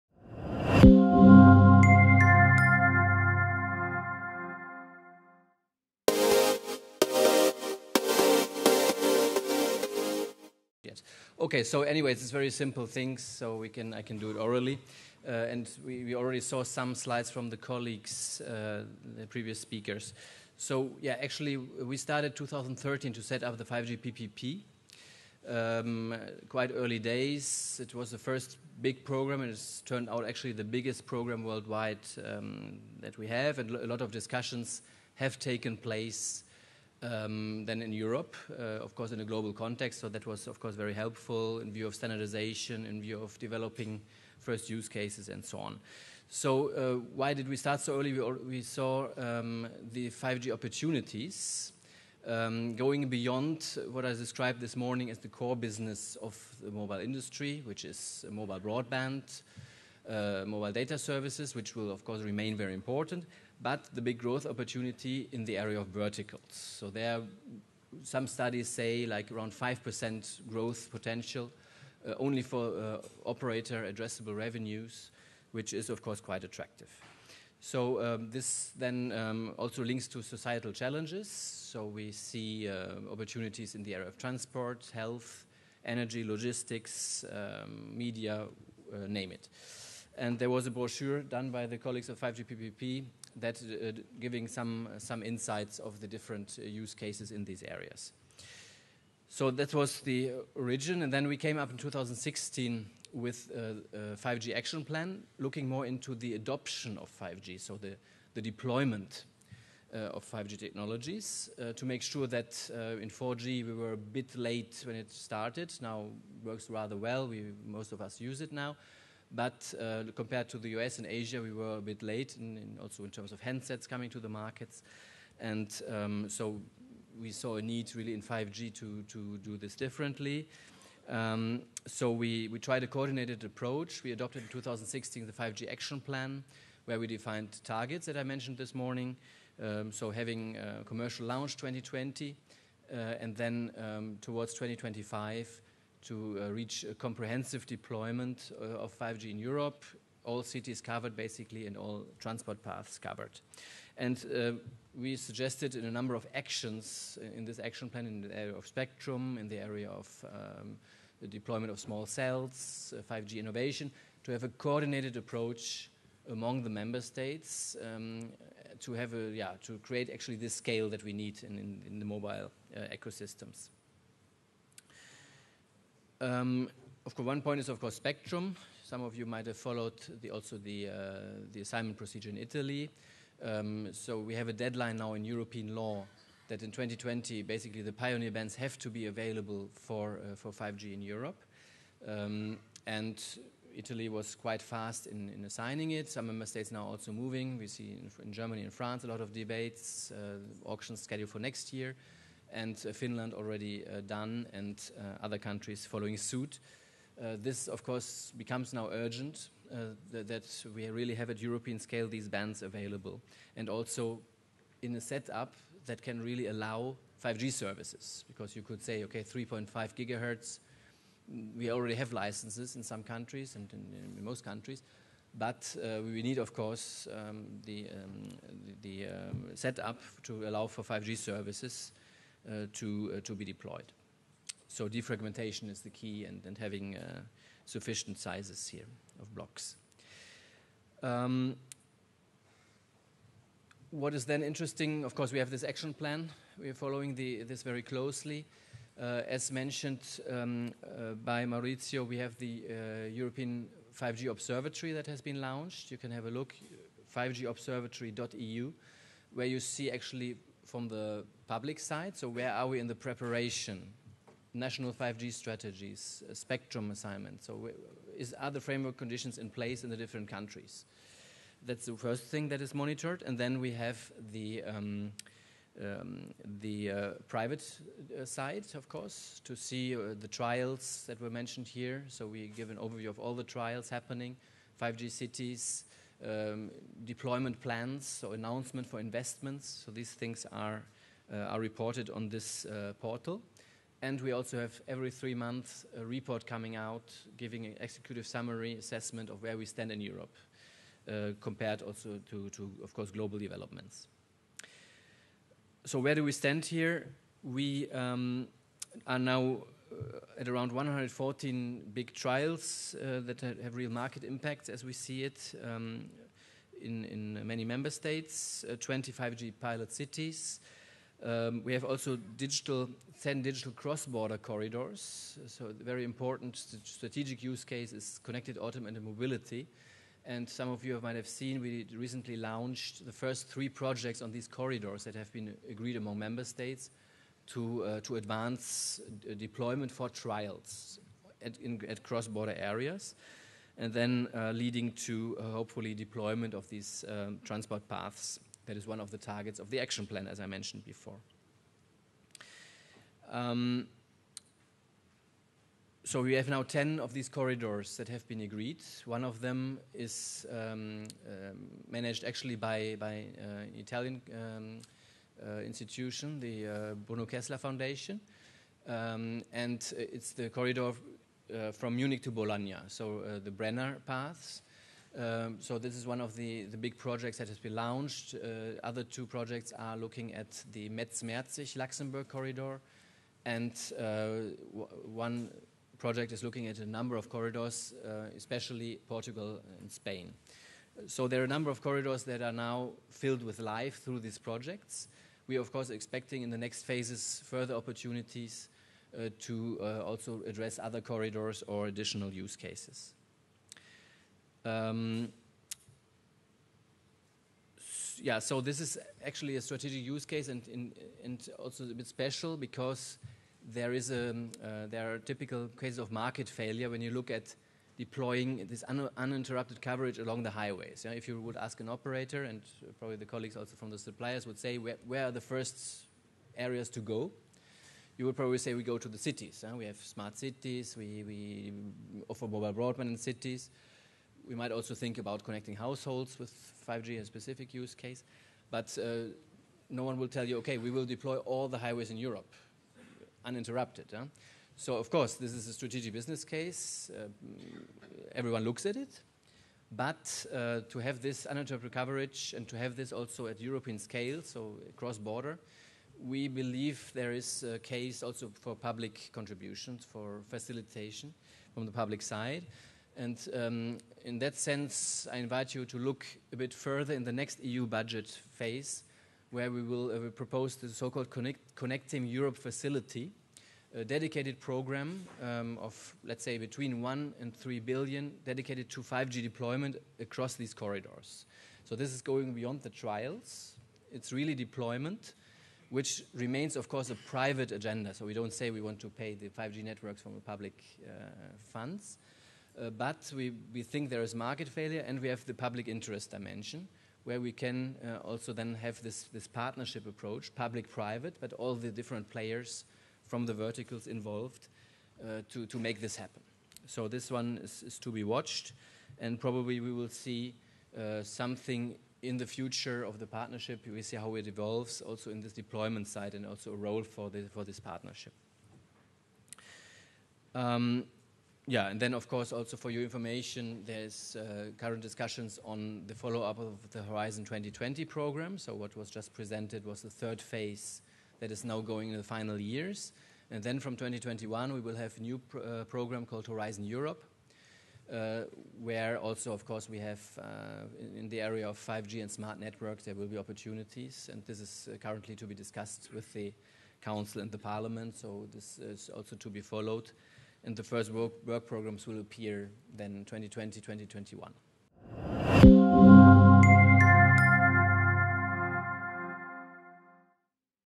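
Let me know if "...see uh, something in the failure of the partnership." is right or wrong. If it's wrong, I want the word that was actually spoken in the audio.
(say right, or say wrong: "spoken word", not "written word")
wrong: "future", not "failure".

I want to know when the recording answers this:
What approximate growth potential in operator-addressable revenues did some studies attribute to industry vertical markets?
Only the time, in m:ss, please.
1:09.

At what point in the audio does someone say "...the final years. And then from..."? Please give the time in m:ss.
8:52.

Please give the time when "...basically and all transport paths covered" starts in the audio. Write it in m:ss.
2:31.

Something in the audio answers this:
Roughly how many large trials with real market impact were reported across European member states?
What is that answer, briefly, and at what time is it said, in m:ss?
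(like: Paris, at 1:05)
114, at 5:10.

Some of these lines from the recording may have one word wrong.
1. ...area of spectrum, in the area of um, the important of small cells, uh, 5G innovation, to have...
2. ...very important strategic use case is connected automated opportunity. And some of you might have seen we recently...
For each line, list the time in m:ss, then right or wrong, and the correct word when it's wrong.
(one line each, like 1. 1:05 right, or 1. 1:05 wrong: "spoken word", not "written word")
1. 2:38 wrong: "deployment", not "important"
2. 5:25 wrong: "mobility", not "opportunity".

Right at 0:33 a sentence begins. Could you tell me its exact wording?
And a lot of discussions have taken place um, than in Europe, uh, of course, in a global context.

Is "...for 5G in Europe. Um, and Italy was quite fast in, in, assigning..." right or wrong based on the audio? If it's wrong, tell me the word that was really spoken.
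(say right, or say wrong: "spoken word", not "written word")
right.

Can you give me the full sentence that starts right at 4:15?
You can have a look, 5gobservatory.eu, where you see actually from the public side.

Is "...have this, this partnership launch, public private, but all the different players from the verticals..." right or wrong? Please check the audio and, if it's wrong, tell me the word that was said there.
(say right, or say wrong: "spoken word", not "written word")
wrong: "approach", not "launch".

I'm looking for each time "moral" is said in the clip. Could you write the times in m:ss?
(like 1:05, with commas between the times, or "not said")
not said.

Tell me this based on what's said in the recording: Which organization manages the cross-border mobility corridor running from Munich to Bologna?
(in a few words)
Bruno Kessler Foundation.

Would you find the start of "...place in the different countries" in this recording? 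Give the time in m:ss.
4:29.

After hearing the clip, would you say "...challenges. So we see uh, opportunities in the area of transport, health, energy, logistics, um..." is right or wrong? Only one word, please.
right.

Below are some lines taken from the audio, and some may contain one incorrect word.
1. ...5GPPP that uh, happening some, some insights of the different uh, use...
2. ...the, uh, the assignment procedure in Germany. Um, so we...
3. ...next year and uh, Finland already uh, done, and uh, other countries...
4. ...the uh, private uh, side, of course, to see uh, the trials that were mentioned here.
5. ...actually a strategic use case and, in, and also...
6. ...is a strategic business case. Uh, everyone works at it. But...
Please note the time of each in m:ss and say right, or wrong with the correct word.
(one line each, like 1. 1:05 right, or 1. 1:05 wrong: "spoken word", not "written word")
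1. 1:32 wrong: "giving", not "happening"
2. 3:00 wrong: "Italy", not "Germany"
3. 3:21 right
4. 4:36 right
5. 6:49 right
6. 7:25 wrong: "looks", not "works".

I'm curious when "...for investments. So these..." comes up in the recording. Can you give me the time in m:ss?
4:48.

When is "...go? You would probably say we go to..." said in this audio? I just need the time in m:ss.
7:06.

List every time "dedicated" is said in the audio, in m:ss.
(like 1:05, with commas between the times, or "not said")
7:54, 7:58.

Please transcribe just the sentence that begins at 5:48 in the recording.
That is one of the targets of the action plan, as I mentioned before.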